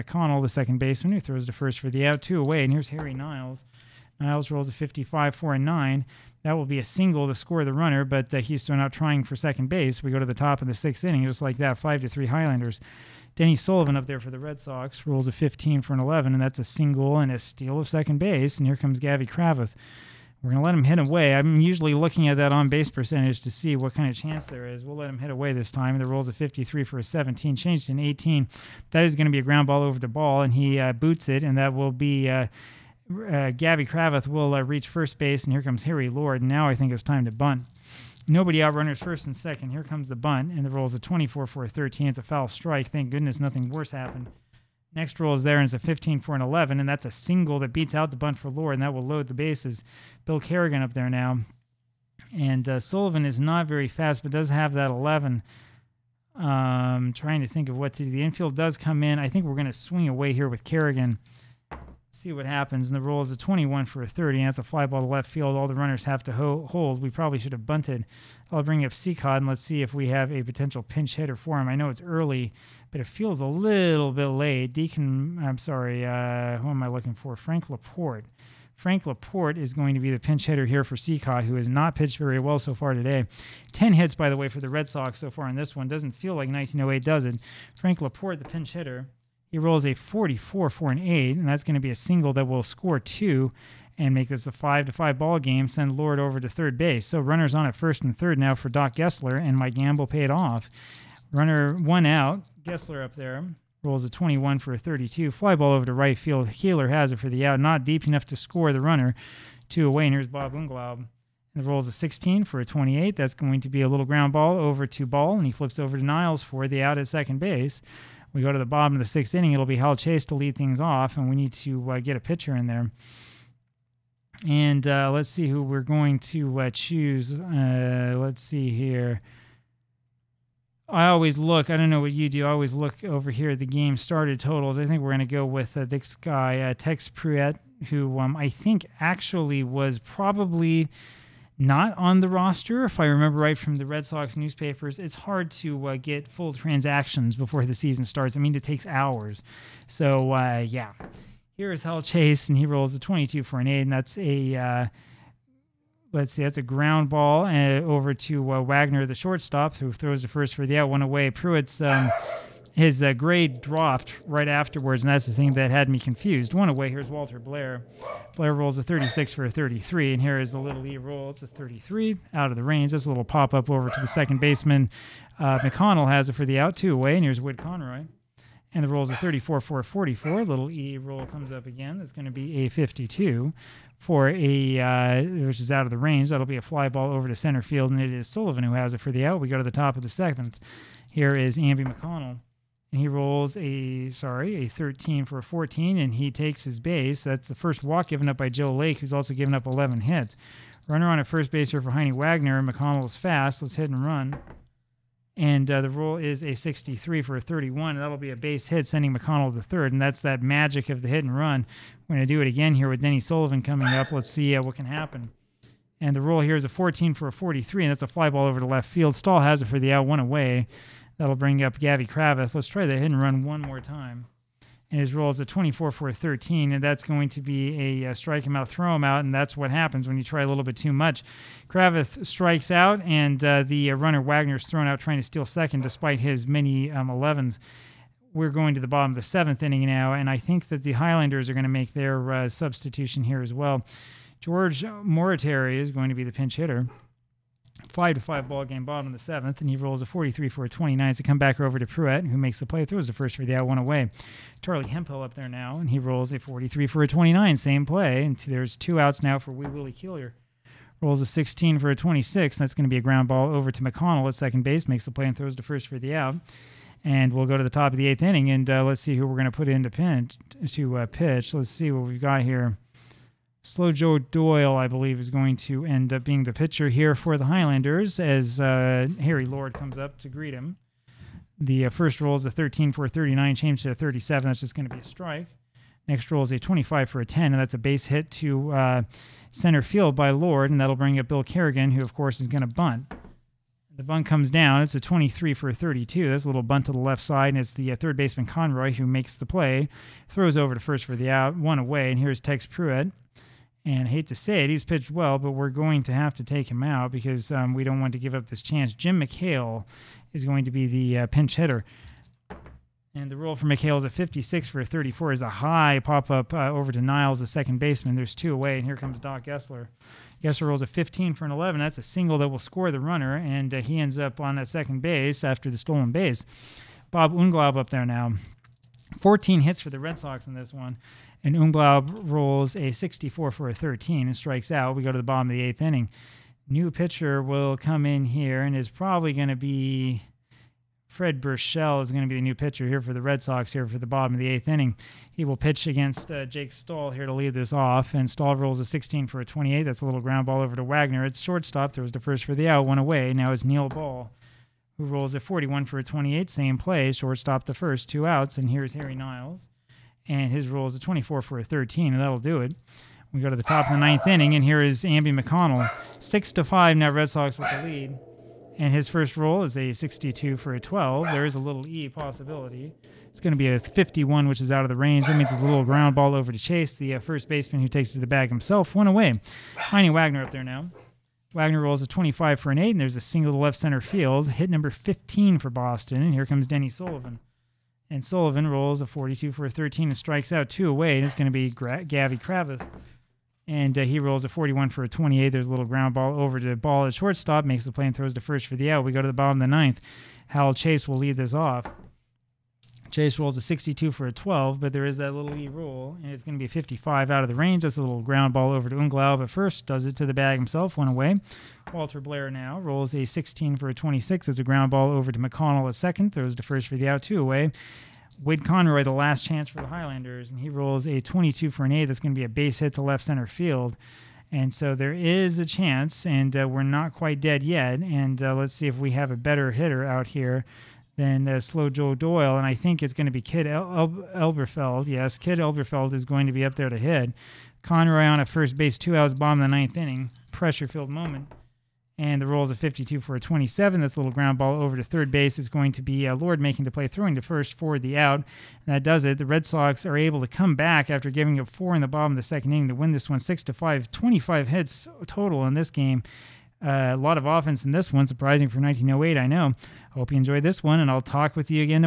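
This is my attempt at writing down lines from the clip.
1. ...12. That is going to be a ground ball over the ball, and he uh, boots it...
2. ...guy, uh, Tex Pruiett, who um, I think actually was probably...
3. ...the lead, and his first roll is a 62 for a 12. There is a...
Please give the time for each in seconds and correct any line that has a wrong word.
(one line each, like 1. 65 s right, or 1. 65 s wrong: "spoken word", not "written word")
1. 27 s wrong: "18", not "12"
2. 136 s right
3. 367 s right.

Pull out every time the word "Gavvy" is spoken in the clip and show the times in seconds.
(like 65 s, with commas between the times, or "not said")
18 s, 221 s, 392 s.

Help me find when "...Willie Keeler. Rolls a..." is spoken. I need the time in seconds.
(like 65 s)
259 s.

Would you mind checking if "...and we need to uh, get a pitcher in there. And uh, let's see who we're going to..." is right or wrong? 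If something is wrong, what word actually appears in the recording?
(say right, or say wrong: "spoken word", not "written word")
right.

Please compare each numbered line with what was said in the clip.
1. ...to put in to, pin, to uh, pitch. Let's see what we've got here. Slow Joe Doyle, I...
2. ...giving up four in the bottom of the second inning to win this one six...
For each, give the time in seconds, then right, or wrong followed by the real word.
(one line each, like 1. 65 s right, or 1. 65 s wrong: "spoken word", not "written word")
1. 269 s right
2. 451 s right.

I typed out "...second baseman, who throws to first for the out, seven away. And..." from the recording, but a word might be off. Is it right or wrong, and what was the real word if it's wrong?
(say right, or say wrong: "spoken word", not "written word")
wrong: "two", not "seven".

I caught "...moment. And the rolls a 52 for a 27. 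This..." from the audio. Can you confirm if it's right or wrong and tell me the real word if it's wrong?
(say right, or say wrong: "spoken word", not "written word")
right.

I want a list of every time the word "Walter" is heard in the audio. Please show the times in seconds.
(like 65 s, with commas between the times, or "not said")
167 s, 411 s.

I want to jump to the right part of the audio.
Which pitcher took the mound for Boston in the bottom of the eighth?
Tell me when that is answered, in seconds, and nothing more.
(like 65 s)
341 s.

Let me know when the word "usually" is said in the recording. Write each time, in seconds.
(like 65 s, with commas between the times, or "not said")
21 s.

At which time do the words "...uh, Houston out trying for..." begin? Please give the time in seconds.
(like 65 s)
8 s.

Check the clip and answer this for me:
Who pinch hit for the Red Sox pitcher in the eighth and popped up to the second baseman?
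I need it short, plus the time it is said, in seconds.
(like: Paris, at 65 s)
Jim McHale, at 308 s.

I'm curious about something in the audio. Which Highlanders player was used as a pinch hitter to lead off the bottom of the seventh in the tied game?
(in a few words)
George Moriarty.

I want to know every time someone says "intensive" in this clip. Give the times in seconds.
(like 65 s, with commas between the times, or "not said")
not said.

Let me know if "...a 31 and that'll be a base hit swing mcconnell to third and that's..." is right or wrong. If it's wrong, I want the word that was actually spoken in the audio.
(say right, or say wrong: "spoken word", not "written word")
wrong: "sending", not "swing".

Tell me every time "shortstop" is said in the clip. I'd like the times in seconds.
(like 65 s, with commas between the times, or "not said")
159 s, 351 s, 357 s, 397 s.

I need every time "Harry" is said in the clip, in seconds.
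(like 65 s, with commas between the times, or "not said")
2 s, 35 s, 279 s, 358 s.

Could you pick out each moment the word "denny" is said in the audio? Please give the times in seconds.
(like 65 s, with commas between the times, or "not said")
13 s, 213 s, 386 s.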